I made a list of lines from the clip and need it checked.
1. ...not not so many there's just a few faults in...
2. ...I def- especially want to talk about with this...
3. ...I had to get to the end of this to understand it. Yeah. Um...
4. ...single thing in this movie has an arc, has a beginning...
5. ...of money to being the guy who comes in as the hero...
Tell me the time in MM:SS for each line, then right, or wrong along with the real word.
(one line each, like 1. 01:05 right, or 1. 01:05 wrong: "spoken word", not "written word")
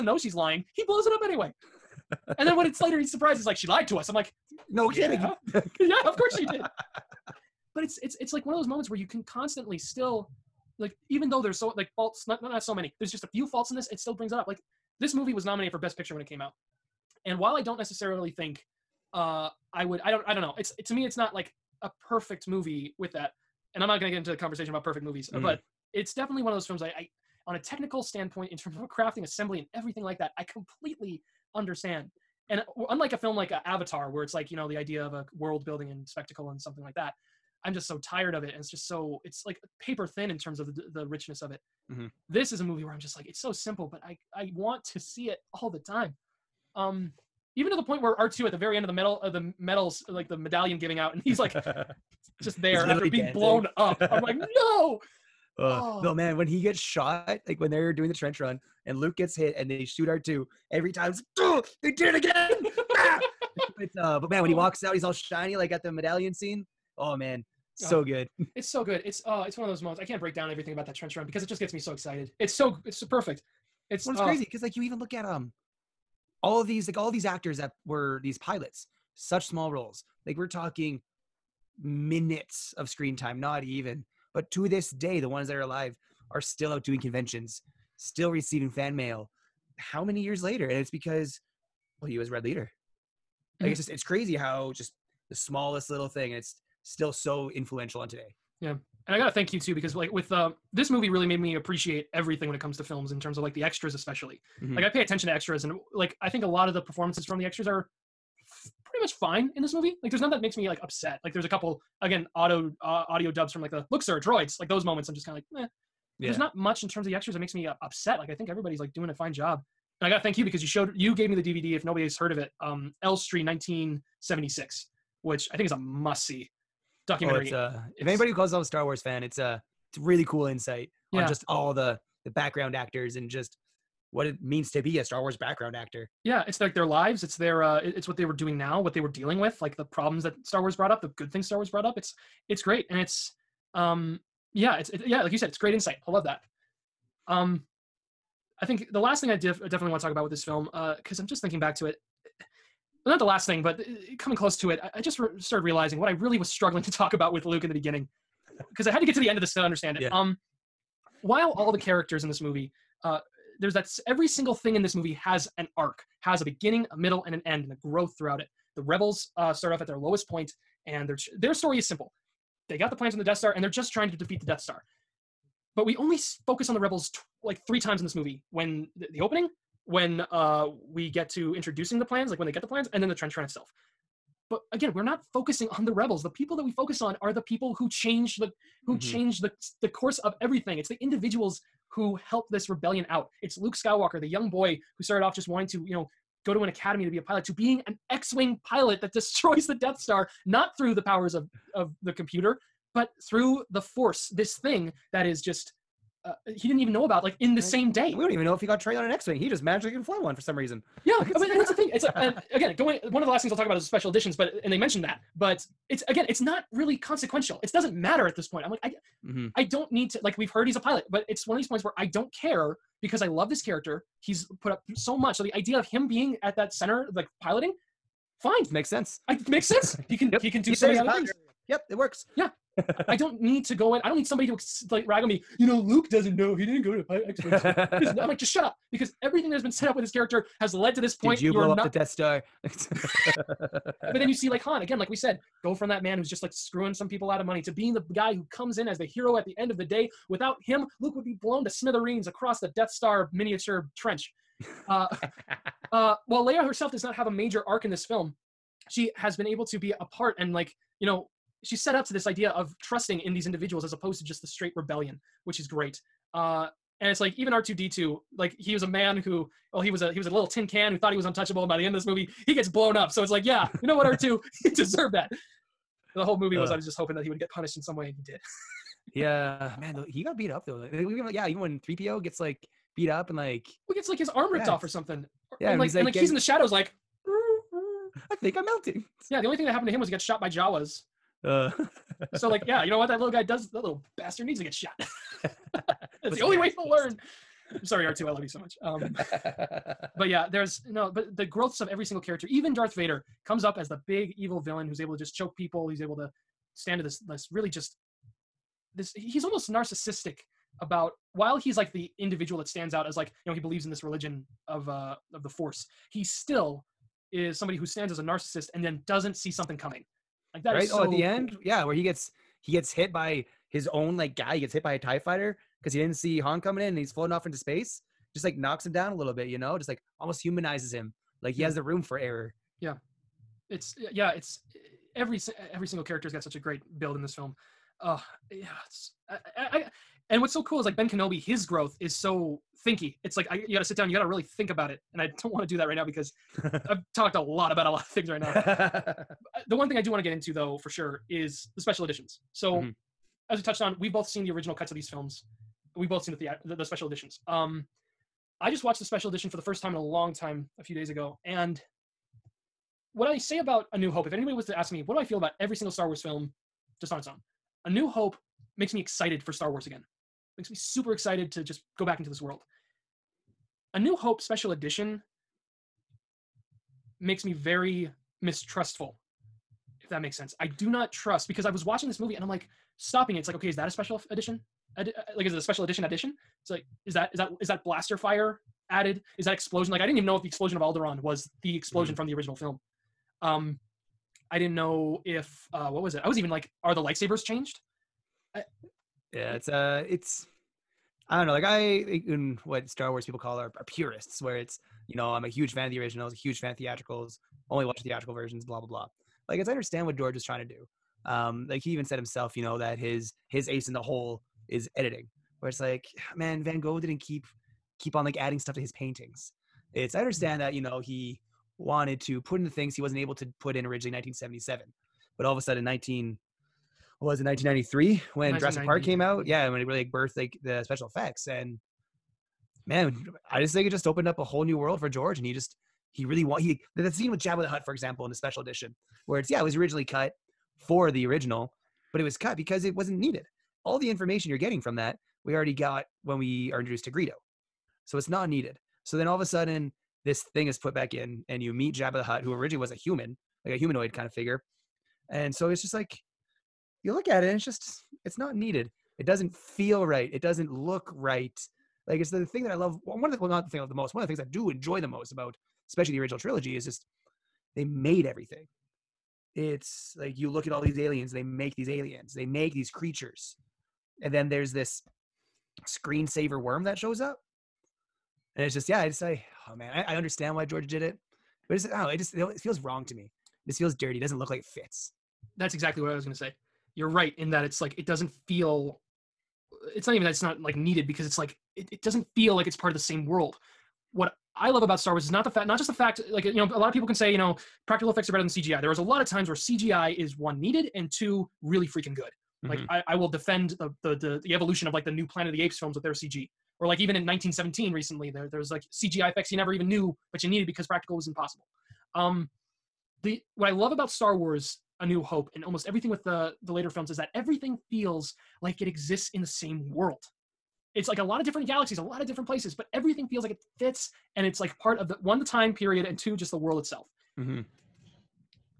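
1. 00:12 right
2. 02:29 wrong: "definitely", not "especially"
3. 02:38 right
4. 02:44 right
5. 04:07 right.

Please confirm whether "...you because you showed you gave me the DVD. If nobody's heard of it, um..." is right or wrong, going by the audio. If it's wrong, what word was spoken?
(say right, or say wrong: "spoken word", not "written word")
right.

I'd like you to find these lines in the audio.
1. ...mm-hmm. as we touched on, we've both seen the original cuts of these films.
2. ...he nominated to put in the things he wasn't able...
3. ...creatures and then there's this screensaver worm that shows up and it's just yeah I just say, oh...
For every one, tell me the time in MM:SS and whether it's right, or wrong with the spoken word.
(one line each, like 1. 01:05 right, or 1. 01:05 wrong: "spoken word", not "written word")
1. 05:52 right
2. 07:00 wrong: "wanted", not "nominated"
3. 07:52 right.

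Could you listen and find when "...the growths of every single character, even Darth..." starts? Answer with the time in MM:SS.
05:01.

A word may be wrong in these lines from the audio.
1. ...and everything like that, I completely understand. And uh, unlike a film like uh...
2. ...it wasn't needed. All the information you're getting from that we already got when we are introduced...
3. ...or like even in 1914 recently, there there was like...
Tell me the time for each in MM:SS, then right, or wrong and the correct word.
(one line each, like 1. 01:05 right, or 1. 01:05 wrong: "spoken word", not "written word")
1. 00:29 right
2. 07:22 right
3. 08:26 wrong: "1917", not "1914".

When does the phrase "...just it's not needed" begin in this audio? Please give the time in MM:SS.
07:37.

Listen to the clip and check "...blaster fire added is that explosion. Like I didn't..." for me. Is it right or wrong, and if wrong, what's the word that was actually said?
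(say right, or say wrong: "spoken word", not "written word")
right.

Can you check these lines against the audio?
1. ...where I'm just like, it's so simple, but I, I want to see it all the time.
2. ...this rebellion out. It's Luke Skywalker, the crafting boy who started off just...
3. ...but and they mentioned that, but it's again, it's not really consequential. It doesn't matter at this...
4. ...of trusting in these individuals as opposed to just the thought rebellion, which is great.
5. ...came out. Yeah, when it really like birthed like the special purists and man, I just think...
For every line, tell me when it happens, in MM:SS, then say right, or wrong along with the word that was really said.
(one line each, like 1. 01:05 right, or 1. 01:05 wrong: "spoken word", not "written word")
1. 00:42 right
2. 03:12 wrong: "young", not "crafting"
3. 03:34 right
4. 04:22 wrong: "straight", not "thought"
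5. 07:09 wrong: "effects", not "purists".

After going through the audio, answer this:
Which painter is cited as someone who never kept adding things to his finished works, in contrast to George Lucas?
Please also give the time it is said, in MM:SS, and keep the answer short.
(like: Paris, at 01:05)
Van Gogh, at 06:56.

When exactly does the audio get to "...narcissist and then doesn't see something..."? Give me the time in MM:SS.
05:18.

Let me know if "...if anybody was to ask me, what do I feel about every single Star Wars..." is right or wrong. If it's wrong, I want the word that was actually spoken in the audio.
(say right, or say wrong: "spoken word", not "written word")
right.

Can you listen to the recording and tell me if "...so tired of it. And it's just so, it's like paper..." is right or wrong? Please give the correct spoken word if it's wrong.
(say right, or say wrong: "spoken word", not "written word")
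right.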